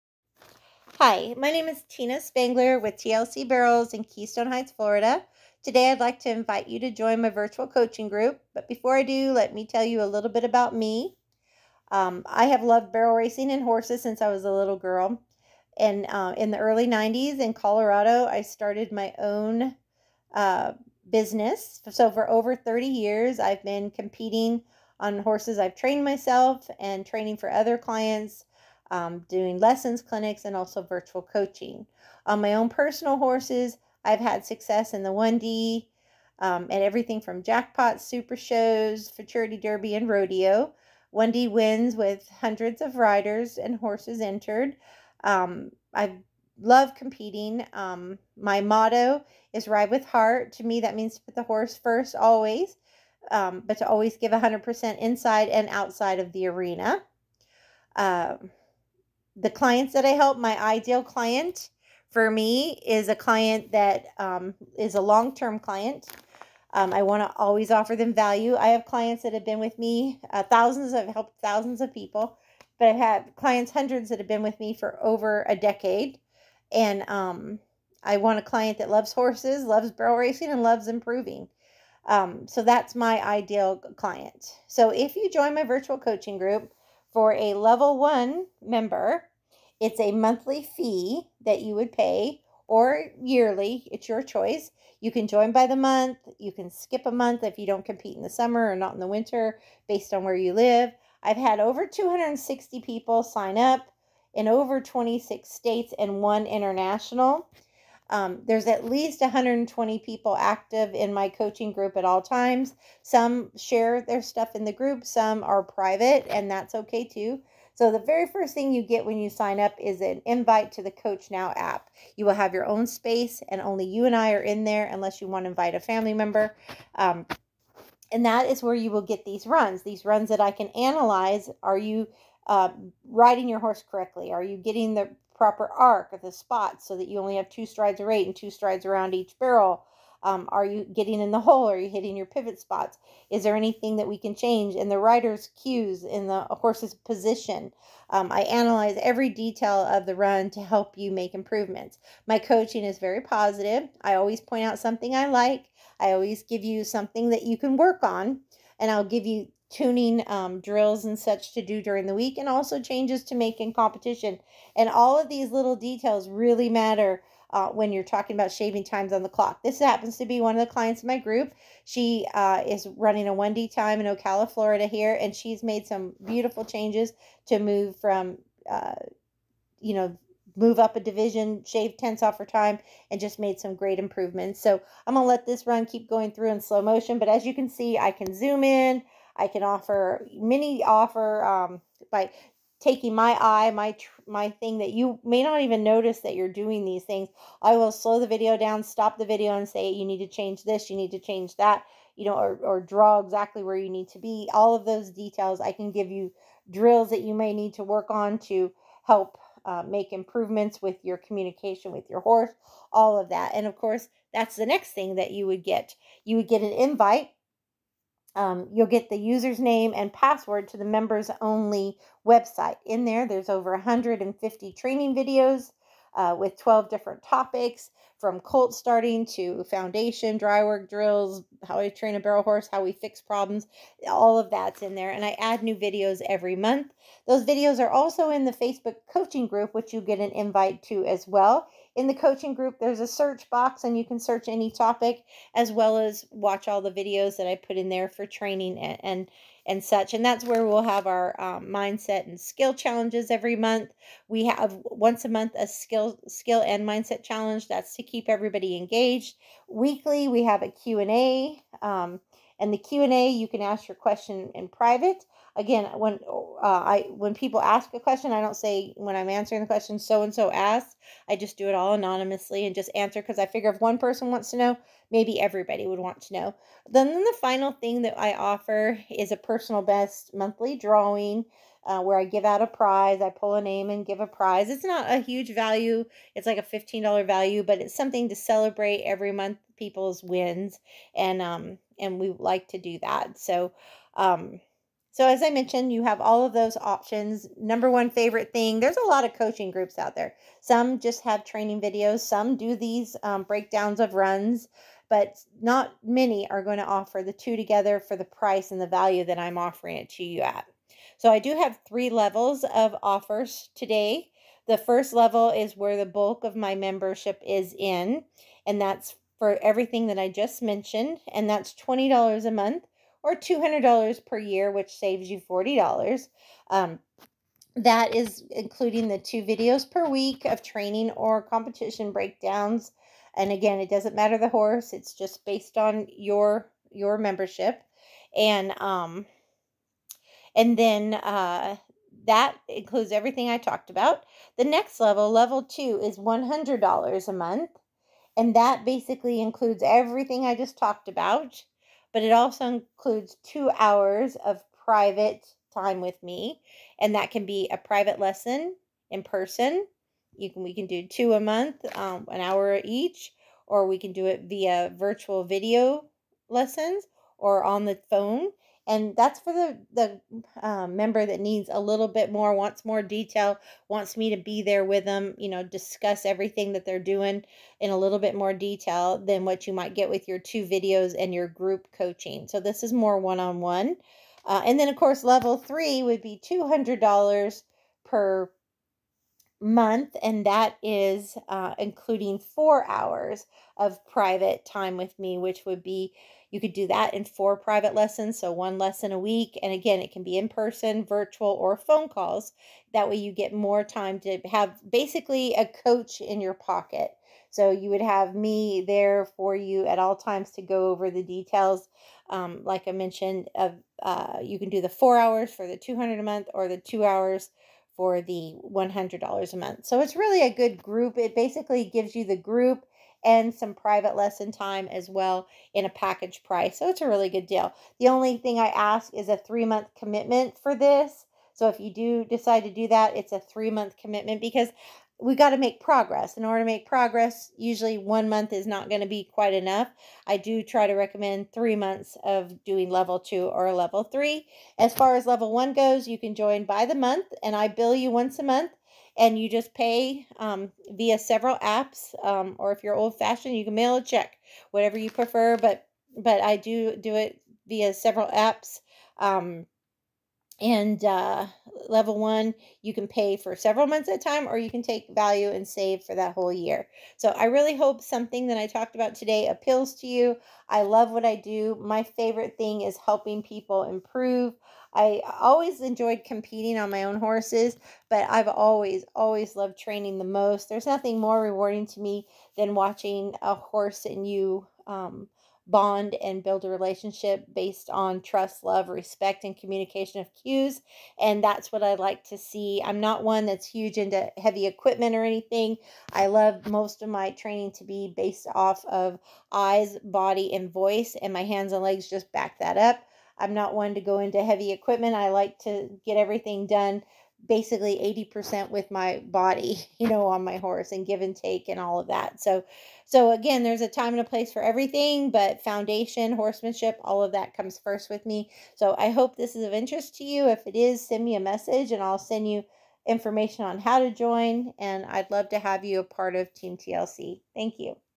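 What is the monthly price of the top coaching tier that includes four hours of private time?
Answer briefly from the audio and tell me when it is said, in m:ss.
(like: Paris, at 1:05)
$200, at 6:26.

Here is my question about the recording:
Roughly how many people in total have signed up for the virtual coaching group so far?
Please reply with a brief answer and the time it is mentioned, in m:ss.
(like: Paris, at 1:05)
260, at 1:41.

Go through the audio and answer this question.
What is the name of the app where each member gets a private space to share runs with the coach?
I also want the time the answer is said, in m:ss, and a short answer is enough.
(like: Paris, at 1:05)
Coach Now, at 2:00.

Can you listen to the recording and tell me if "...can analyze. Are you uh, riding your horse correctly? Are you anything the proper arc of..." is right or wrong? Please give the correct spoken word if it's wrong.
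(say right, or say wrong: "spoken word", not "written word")
wrong: "getting", not "anything".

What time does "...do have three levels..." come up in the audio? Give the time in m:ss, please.
5:11.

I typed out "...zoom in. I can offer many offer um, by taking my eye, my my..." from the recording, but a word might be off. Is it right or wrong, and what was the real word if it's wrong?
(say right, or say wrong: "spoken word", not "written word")
right.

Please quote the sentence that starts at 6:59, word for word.
So it's really a good group.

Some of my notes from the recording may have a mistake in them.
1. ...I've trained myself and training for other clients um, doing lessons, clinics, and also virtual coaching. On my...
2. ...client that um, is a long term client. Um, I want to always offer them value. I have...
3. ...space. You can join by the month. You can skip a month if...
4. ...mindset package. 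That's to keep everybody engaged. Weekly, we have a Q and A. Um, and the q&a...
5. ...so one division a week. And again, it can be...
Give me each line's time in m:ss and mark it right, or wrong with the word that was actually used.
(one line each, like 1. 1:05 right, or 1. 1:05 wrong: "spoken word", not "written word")
1. 0:25 right
2. 1:03 right
3. 1:34 wrong: "choice", not "space"
4. 4:16 wrong: "challenge", not "package"
5. 6:38 wrong: "lesson", not "division".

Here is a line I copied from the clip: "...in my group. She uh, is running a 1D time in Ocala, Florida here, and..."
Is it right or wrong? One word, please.
right.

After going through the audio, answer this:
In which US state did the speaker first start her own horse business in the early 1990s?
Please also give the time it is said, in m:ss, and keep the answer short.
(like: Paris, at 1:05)
Colorado, at 0:17.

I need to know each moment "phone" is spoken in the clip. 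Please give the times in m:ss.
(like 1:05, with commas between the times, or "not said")
6:08, 6:41.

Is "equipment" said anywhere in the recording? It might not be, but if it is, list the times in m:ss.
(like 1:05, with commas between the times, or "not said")
8:14, 8:24.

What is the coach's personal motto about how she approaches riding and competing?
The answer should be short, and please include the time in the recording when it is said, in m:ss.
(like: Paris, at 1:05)
Ride with heart, at 0:49.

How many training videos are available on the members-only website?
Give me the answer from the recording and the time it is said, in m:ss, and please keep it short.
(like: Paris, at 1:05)
150, at 3:43.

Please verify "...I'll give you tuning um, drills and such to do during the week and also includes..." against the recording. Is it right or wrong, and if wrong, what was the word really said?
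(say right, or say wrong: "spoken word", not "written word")
wrong: "changes", not "includes".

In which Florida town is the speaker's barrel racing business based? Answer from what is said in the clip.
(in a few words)
Keystone Heights.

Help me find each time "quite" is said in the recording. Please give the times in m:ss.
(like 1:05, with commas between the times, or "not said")
7:19.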